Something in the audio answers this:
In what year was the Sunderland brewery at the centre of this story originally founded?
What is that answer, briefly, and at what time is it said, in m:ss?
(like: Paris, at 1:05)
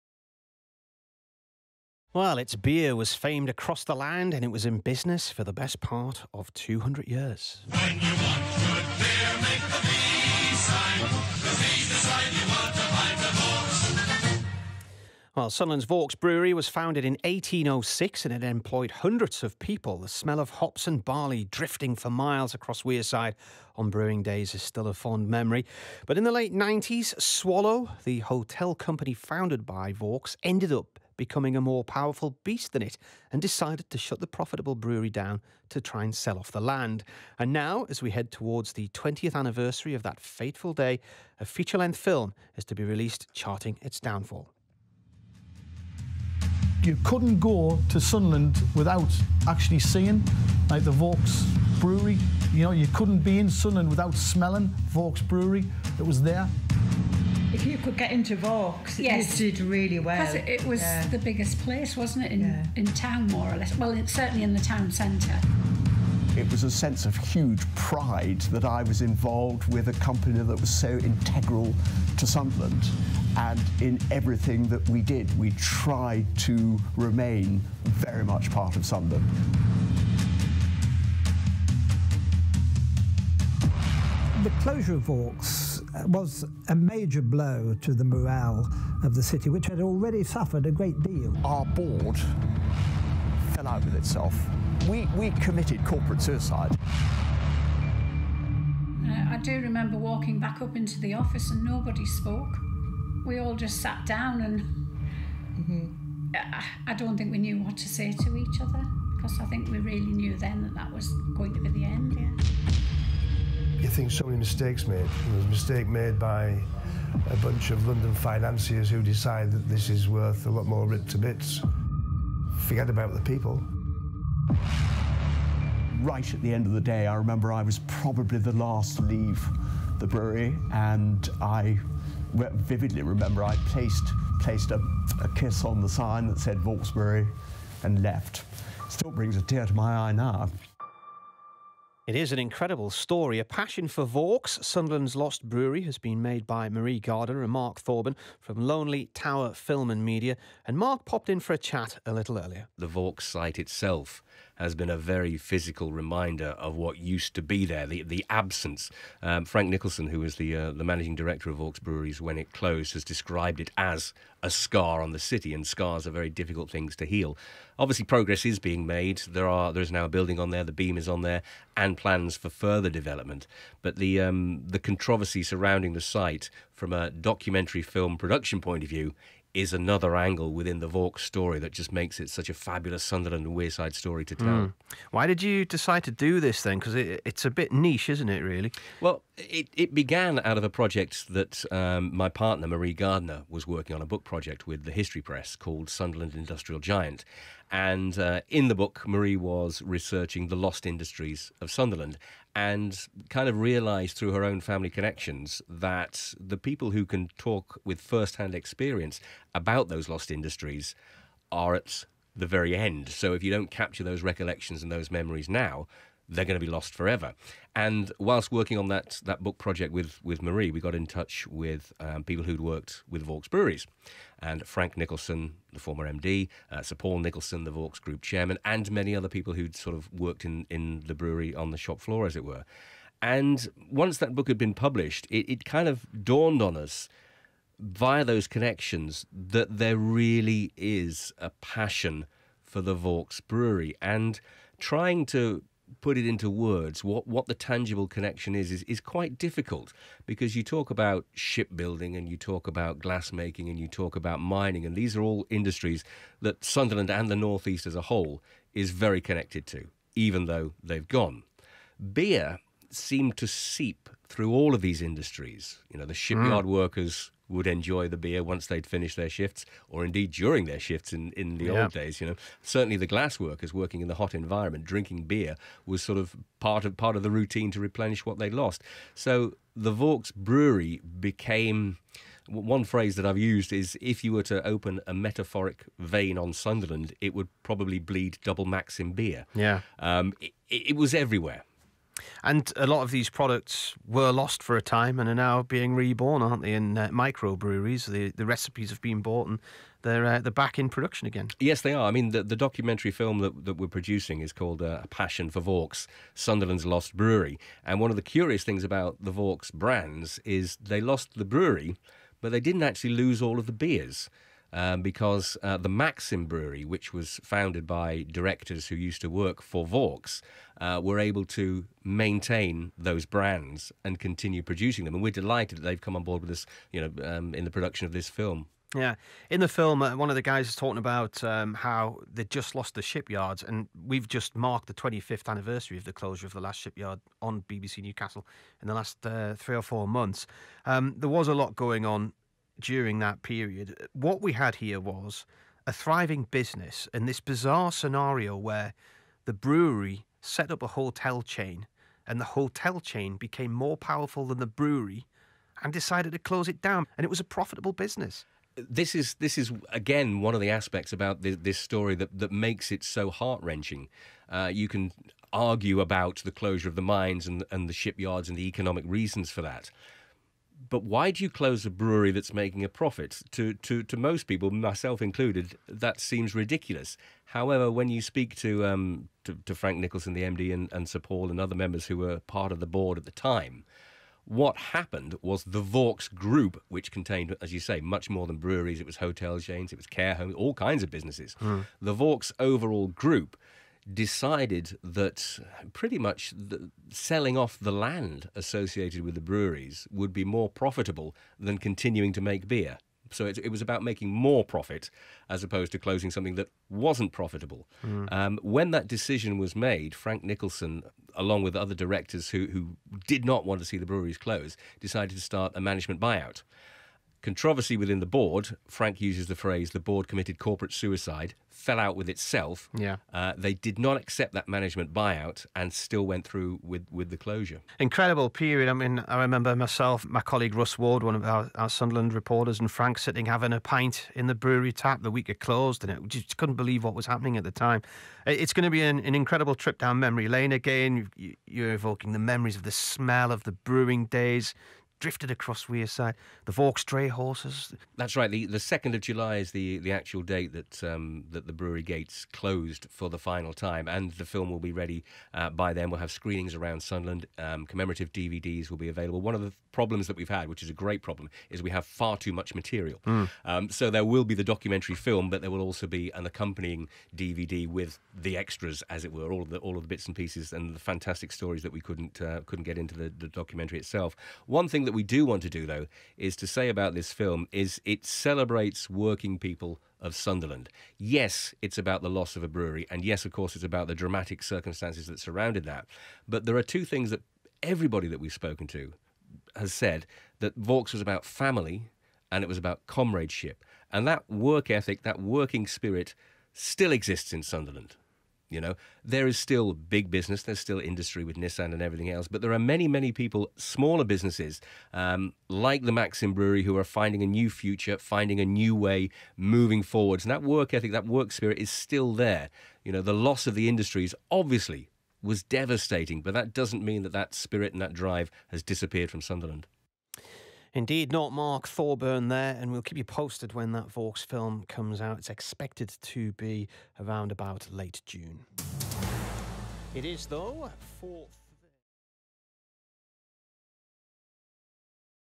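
1806, at 0:17.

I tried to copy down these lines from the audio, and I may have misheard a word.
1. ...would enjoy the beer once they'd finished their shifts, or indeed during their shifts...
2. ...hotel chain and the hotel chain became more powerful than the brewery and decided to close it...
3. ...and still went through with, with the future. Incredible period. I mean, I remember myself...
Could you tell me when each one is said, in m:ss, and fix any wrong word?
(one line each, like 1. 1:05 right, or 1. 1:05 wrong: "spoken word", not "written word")
1. 4:27 right
2. 5:50 right
3. 7:05 wrong: "closure", not "future".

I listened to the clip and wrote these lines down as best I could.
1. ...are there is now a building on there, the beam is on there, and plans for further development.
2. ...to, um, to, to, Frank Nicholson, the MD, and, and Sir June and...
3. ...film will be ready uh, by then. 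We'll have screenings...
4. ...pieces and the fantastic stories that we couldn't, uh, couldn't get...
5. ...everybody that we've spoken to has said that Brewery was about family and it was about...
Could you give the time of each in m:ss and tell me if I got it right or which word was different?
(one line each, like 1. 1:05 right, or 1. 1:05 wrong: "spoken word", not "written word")
1. 2:49 right
2. 6:18 wrong: "Paul", not "June"
3. 7:34 right
4. 7:50 right
5. 8:07 wrong: "Vaux", not "Brewery".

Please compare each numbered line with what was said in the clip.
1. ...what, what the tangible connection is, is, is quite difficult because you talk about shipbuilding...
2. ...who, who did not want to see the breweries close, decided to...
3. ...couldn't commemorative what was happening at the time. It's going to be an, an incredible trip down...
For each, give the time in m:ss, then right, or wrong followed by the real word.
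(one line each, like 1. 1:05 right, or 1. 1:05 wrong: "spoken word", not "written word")
1. 4:07 right
2. 6:52 right
3. 7:16 wrong: "believe", not "commemorative".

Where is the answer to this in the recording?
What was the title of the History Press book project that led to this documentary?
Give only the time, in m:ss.
3:15.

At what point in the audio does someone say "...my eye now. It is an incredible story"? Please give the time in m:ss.
2:19.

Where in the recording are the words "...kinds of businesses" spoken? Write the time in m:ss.
6:30.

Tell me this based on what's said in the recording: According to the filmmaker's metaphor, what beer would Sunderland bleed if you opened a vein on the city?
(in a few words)
double Maxim.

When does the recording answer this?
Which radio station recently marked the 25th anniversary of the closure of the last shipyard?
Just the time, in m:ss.
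5:37.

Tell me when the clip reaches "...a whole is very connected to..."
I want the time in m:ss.
4:17.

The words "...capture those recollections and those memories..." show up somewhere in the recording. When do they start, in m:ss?
3:33.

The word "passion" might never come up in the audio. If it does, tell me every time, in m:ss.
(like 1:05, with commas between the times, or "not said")
2:23, 4:01, 5:05.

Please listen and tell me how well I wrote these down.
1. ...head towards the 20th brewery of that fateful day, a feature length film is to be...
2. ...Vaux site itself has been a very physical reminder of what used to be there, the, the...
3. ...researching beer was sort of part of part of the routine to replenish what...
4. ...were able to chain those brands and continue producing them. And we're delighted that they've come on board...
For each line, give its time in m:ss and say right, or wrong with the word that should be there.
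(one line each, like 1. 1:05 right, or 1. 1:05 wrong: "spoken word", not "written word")
1. 0:38 wrong: "anniversary", not "brewery"
2. 2:32 right
3. 4:34 wrong: "drinking", not "researching"
4. 5:21 wrong: "maintain", not "chain".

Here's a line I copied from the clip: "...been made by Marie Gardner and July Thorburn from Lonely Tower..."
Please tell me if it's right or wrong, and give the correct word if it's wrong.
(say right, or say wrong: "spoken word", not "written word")
wrong: "Mark", not "July".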